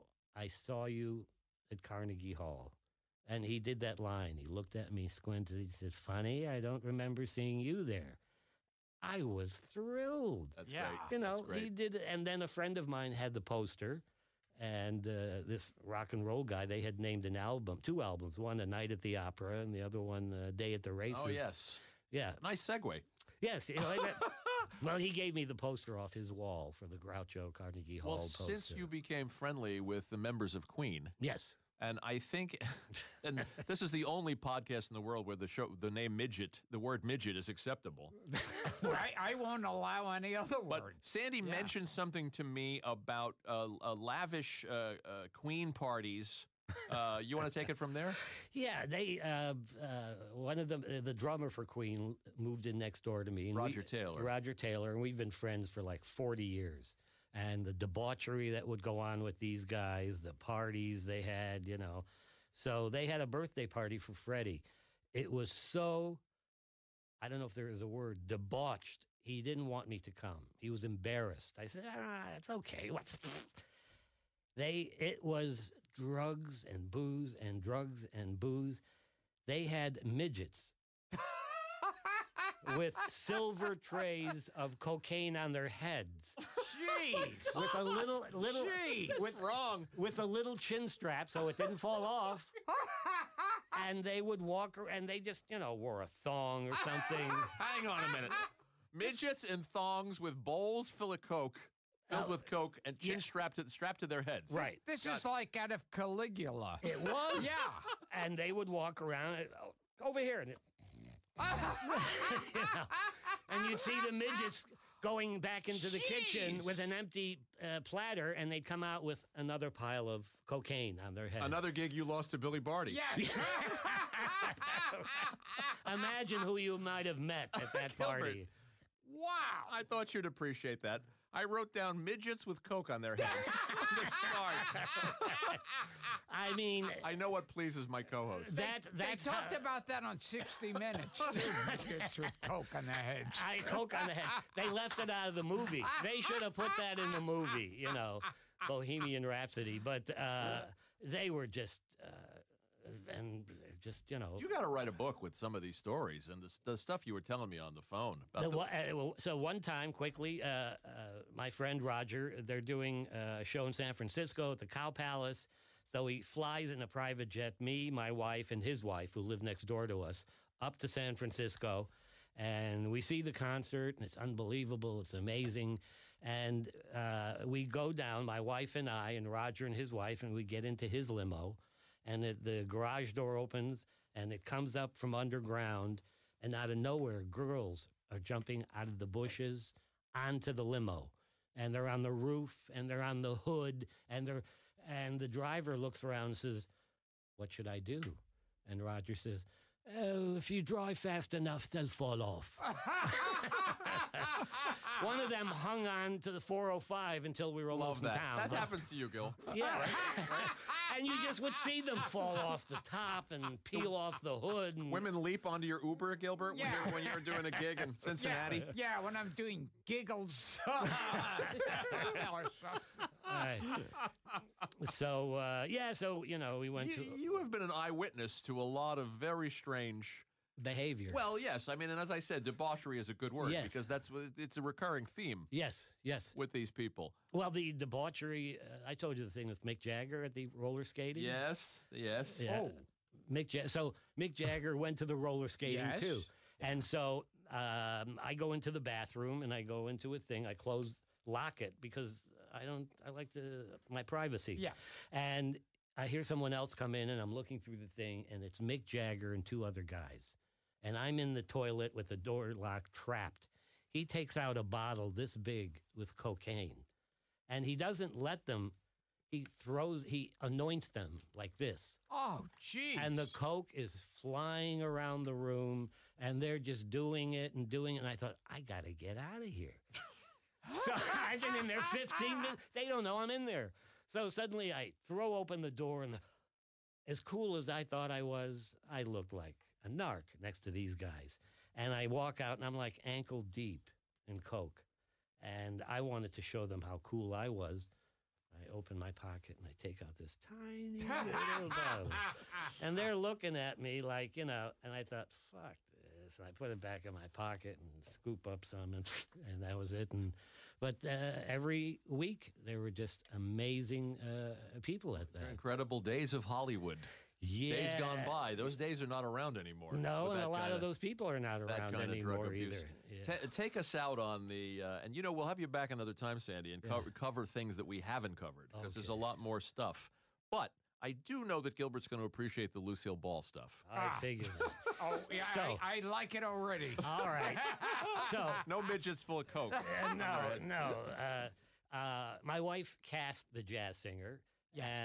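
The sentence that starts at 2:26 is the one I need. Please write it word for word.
They should have put that in the movie.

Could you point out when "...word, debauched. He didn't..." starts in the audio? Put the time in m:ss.
1:07.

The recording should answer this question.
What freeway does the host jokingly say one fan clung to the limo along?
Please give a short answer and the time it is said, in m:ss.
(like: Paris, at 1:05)
405, at 3:26.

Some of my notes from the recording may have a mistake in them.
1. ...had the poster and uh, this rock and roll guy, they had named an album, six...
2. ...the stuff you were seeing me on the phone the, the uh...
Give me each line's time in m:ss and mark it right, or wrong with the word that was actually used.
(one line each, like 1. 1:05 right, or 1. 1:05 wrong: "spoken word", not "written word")
1. 0:13 wrong: "two", not "six"
2. 2:36 wrong: "telling", not "seeing".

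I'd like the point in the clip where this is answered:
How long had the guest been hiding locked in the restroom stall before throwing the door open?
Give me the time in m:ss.
4:41.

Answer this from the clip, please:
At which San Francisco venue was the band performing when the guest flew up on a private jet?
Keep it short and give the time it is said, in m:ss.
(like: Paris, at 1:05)
Cow Palace, at 2:44.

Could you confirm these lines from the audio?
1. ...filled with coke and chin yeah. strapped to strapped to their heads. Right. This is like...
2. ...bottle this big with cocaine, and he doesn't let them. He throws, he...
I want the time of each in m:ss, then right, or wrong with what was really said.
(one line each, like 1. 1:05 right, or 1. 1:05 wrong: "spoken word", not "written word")
1. 1:42 right
2. 4:24 right.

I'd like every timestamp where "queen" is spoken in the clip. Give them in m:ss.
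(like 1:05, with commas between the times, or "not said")
0:30, 0:45, 0:51.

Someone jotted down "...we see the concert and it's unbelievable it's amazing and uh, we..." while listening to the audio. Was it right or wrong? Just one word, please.
right.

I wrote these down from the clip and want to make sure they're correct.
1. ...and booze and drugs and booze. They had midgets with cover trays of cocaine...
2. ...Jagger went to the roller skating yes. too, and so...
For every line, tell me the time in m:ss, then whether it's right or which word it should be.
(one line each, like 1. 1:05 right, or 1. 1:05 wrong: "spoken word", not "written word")
1. 1:16 wrong: "silver", not "cover"
2. 4:04 right.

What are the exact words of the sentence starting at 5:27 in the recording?
cover things that we haven't covered because okay.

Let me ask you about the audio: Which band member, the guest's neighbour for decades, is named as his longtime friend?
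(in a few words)
Roger Taylor.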